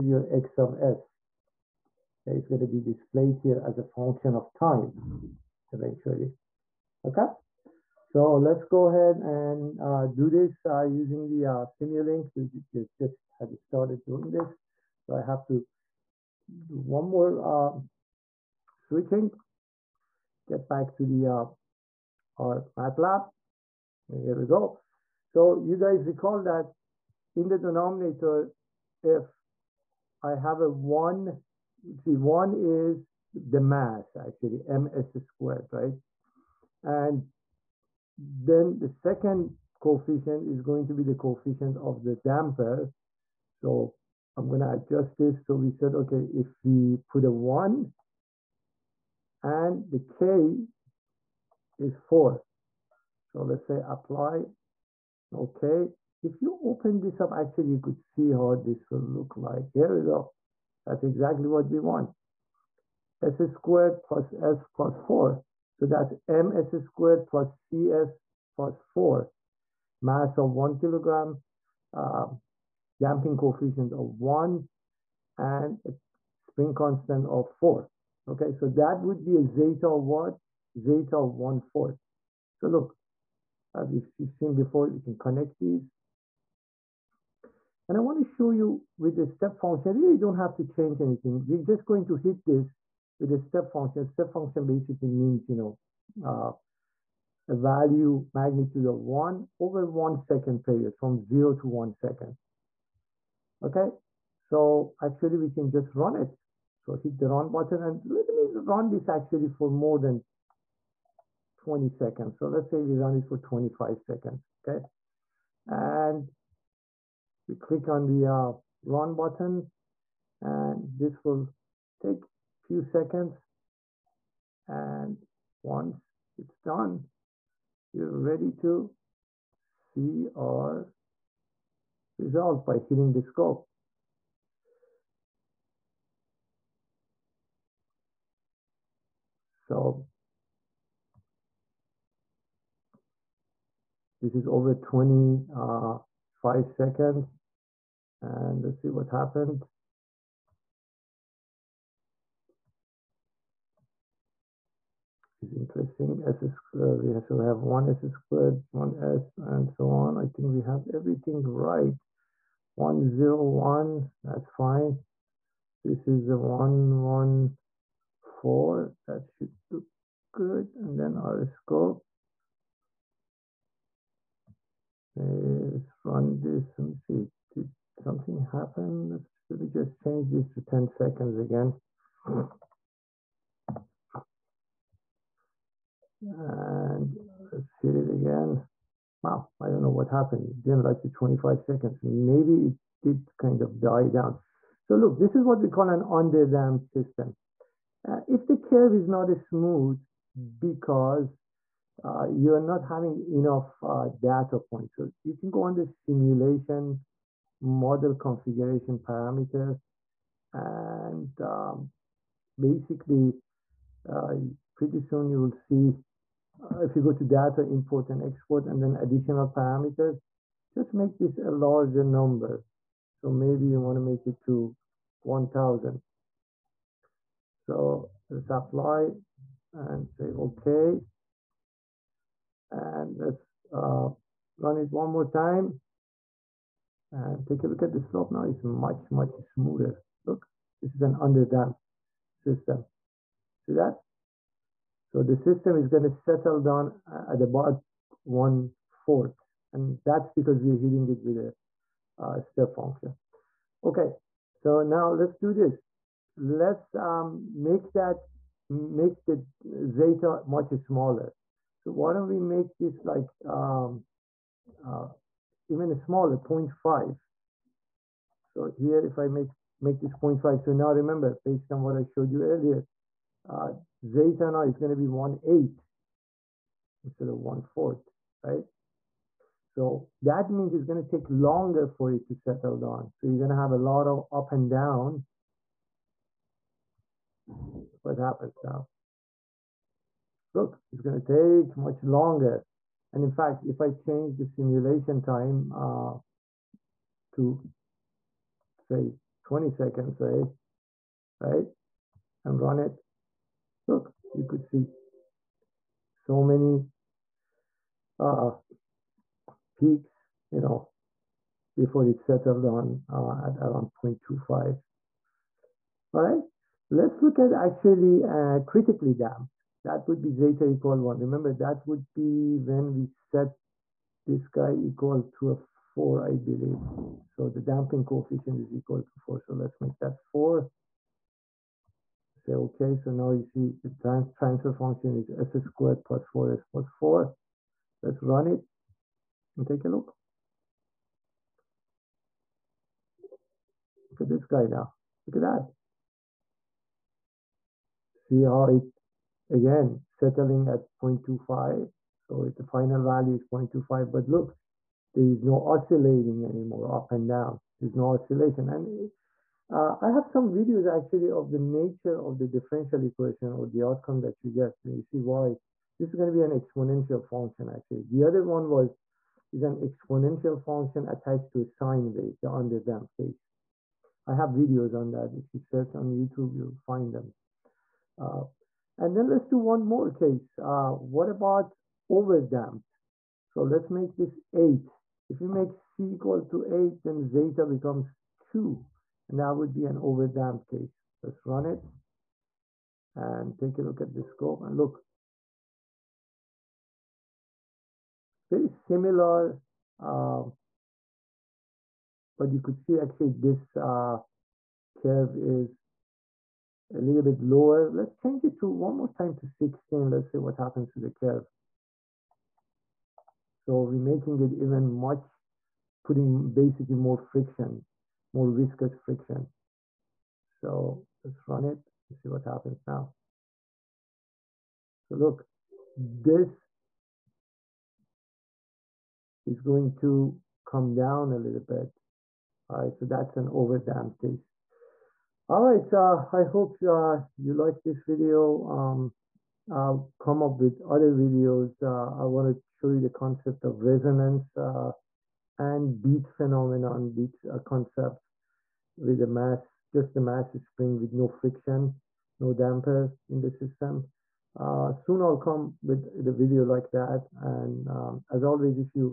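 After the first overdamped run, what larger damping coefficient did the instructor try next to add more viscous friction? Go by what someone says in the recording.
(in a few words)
16.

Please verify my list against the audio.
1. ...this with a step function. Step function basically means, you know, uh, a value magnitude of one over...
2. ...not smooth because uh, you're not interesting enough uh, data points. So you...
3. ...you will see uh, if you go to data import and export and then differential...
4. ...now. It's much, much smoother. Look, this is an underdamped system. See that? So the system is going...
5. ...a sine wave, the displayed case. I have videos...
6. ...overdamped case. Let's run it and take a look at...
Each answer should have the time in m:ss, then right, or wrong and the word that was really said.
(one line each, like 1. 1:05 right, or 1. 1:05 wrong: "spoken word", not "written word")
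1. 1:32 right
2. 3:19 wrong: "having", not "interesting"
3. 3:35 wrong: "additional", not "differential"
4. 3:58 right
5. 6:11 wrong: "underdamped", not "displayed"
6. 6:29 right.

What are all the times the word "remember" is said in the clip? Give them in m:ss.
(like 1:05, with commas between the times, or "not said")
4:30, 5:21.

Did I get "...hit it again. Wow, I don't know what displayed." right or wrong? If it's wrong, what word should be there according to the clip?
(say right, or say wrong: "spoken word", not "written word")
wrong: "happened", not "displayed".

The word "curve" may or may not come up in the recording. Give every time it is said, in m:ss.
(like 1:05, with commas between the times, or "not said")
3:18, 6:45, 6:51.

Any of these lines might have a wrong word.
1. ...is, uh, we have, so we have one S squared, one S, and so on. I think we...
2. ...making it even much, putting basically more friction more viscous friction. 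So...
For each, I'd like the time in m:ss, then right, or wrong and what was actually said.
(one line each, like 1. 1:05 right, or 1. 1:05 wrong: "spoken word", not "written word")
1. 2:36 right
2. 6:53 right.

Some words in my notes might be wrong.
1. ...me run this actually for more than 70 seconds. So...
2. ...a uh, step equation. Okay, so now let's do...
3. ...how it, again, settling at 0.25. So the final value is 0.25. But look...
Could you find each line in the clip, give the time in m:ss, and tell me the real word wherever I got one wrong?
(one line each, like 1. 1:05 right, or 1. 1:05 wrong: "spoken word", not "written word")
1. 1:48 wrong: "20", not "70"
2. 4:11 wrong: "function", not "equation"
3. 5:48 right.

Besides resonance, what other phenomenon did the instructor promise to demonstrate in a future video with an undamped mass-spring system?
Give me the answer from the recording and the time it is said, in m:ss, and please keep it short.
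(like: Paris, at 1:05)
beat phenomenon, at 7:26.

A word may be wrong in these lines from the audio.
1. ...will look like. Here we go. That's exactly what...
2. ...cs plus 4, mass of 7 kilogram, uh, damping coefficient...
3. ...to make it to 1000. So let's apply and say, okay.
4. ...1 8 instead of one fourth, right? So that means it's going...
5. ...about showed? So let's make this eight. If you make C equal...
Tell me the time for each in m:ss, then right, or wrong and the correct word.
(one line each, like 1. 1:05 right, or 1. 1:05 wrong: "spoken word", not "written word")
1. 0:58 right
2. 1:07 wrong: "1", not "7"
3. 3:43 right
4. 4:35 right
5. 6:21 wrong: "overdamped", not "showed".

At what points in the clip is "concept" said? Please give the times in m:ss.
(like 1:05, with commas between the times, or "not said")
7:23, 7:27.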